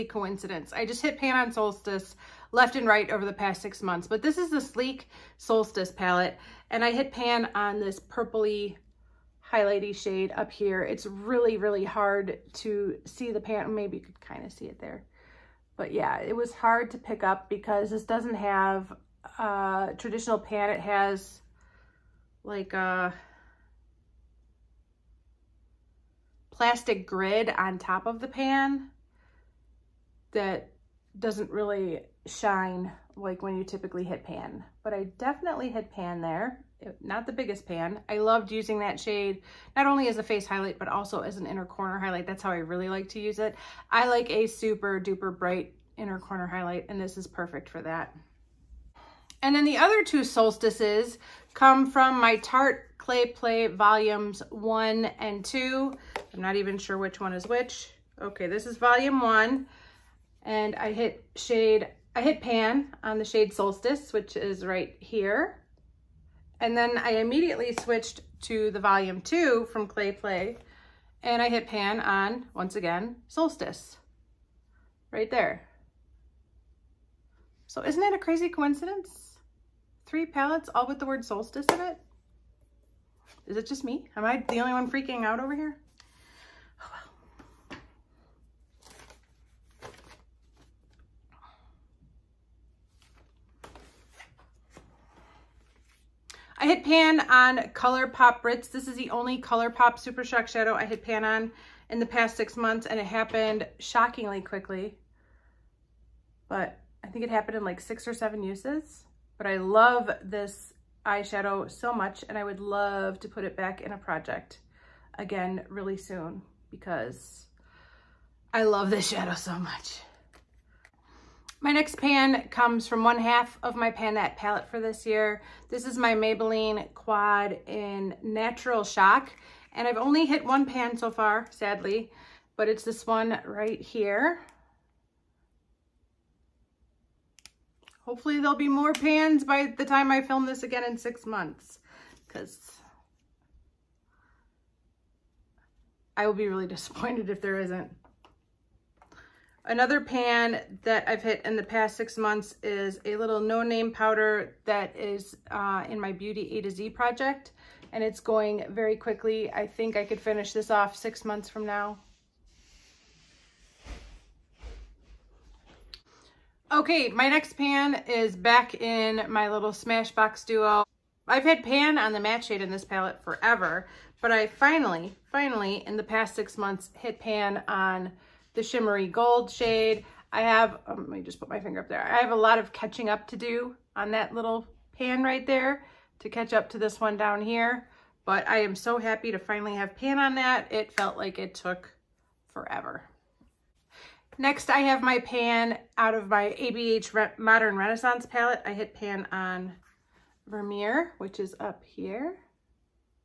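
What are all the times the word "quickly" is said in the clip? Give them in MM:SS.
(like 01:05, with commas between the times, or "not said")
01:44, 02:38.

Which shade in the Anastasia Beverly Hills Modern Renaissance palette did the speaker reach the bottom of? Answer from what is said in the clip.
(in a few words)
Vermeer.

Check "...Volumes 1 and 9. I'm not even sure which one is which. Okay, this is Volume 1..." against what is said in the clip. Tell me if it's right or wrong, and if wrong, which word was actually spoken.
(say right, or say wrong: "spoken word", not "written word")
wrong: "2", not "9".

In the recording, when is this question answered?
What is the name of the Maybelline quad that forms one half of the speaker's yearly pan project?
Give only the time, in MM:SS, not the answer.
02:08.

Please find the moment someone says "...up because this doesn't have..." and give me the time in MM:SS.
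00:17.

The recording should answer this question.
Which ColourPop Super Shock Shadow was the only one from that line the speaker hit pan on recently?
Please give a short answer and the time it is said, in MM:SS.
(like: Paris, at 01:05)
Brits, at 01:38.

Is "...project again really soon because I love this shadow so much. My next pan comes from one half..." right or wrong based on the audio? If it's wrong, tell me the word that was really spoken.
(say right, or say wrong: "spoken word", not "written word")
right.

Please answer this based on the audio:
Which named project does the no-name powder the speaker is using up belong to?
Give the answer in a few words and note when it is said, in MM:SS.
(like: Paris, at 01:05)
Beauty A to Z, at 02:36.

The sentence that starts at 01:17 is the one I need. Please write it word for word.
So isn't that a crazy coincidence?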